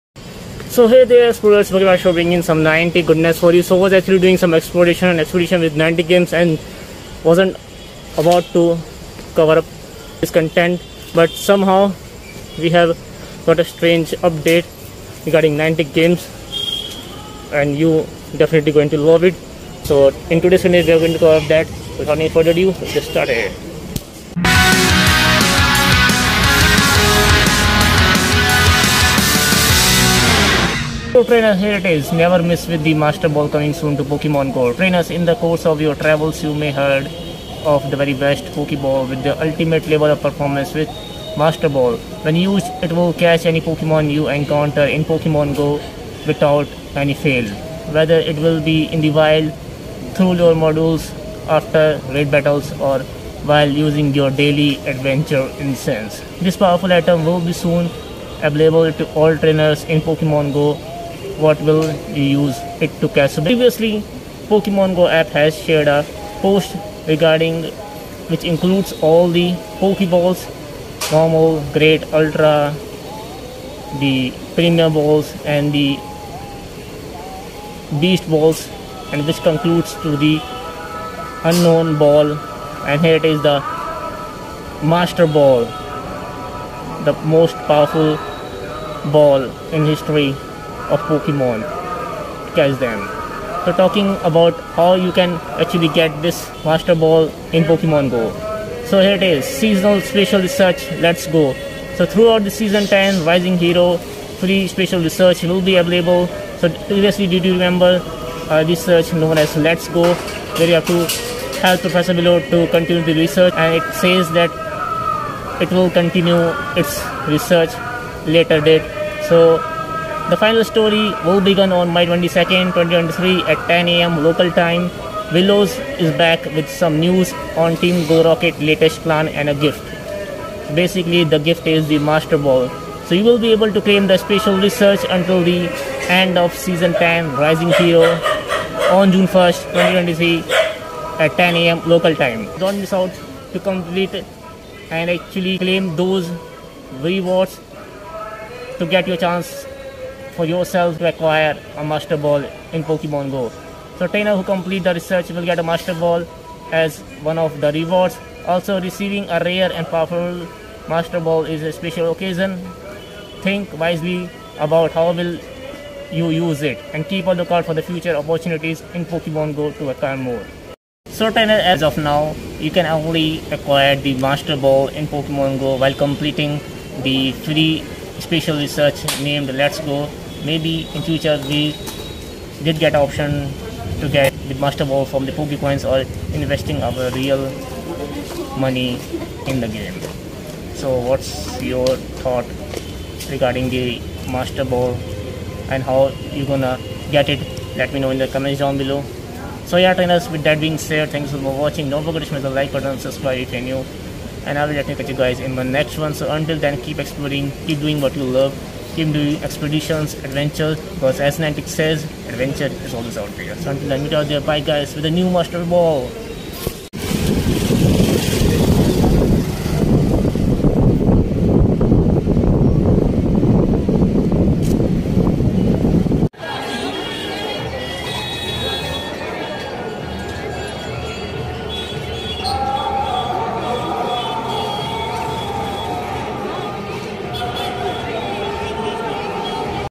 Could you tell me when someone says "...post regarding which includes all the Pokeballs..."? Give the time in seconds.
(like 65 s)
66 s.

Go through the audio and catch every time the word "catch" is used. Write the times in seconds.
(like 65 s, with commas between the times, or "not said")
43 s, 63 s, 92 s, 205 s.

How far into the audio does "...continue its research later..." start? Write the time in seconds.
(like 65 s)
115 s.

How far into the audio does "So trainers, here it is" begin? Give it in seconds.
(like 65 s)
31 s.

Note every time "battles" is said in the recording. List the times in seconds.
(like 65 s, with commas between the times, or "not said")
52 s.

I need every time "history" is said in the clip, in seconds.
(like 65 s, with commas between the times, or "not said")
89 s.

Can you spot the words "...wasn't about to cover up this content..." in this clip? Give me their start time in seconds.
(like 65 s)
7 s.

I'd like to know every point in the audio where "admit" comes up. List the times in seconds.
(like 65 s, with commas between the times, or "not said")
not said.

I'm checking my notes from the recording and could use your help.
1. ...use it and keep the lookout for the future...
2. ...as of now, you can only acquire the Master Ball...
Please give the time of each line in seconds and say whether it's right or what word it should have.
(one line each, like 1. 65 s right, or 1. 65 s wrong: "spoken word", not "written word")
1. 166 s right
2. 171 s right.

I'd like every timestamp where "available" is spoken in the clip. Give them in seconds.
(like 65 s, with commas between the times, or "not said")
58 s, 105 s.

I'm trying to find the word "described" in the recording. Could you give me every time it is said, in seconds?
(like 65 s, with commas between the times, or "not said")
not said.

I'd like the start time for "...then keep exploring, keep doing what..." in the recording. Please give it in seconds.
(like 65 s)
206 s.